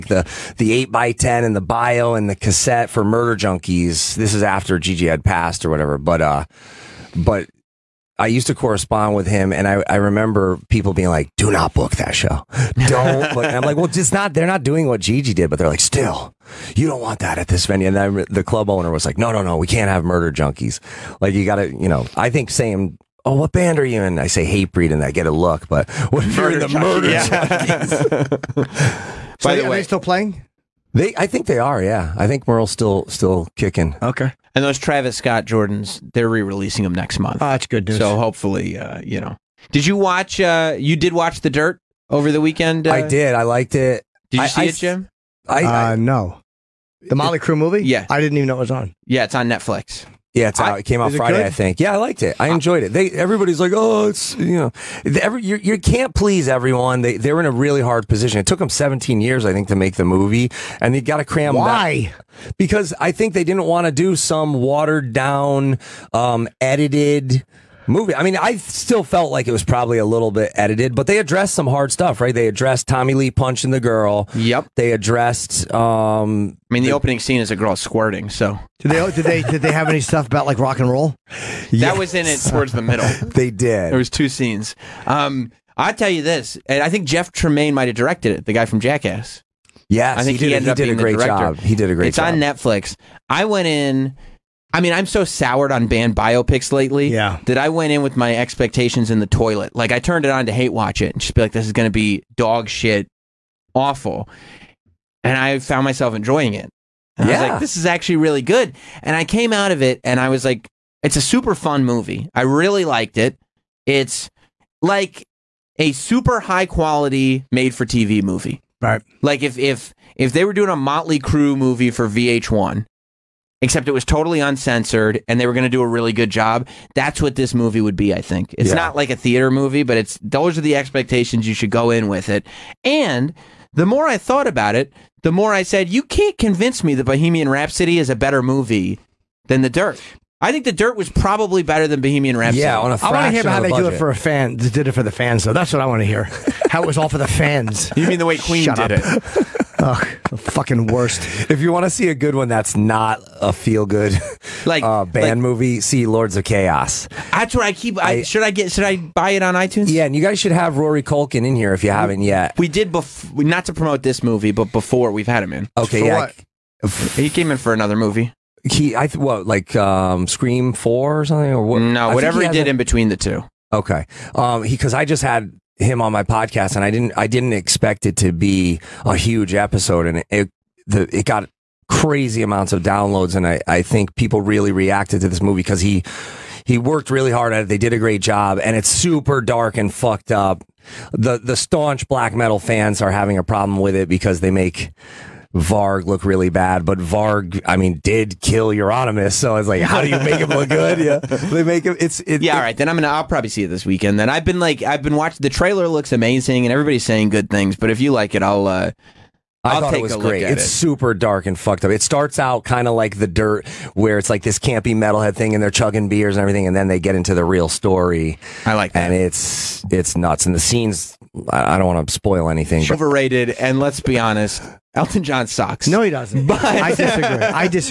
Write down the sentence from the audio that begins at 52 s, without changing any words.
They everybody's like, oh, it's you know, every you, you can't please everyone.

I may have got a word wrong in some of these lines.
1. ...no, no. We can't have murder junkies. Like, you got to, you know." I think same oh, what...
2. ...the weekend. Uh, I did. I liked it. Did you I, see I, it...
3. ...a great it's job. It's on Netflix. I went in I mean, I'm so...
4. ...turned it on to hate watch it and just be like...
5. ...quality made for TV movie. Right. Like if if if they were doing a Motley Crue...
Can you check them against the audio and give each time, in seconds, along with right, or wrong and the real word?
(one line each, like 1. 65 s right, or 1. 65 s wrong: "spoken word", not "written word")
1. 19 s right
2. 42 s right
3. 91 s right
4. 99 s right
5. 116 s right.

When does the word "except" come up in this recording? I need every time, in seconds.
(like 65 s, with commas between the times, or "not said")
123 s.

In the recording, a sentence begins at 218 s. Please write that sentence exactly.
I like that, and it's it's nuts.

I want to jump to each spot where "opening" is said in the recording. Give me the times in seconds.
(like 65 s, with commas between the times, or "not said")
76 s.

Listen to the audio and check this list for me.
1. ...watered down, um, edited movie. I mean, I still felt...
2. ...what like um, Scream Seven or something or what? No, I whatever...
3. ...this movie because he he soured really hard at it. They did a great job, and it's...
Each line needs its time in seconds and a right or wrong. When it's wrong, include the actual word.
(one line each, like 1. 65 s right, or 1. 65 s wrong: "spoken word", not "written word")
1. 64 s right
2. 169 s wrong: "Four", not "Seven"
3. 185 s wrong: "worked", not "soured".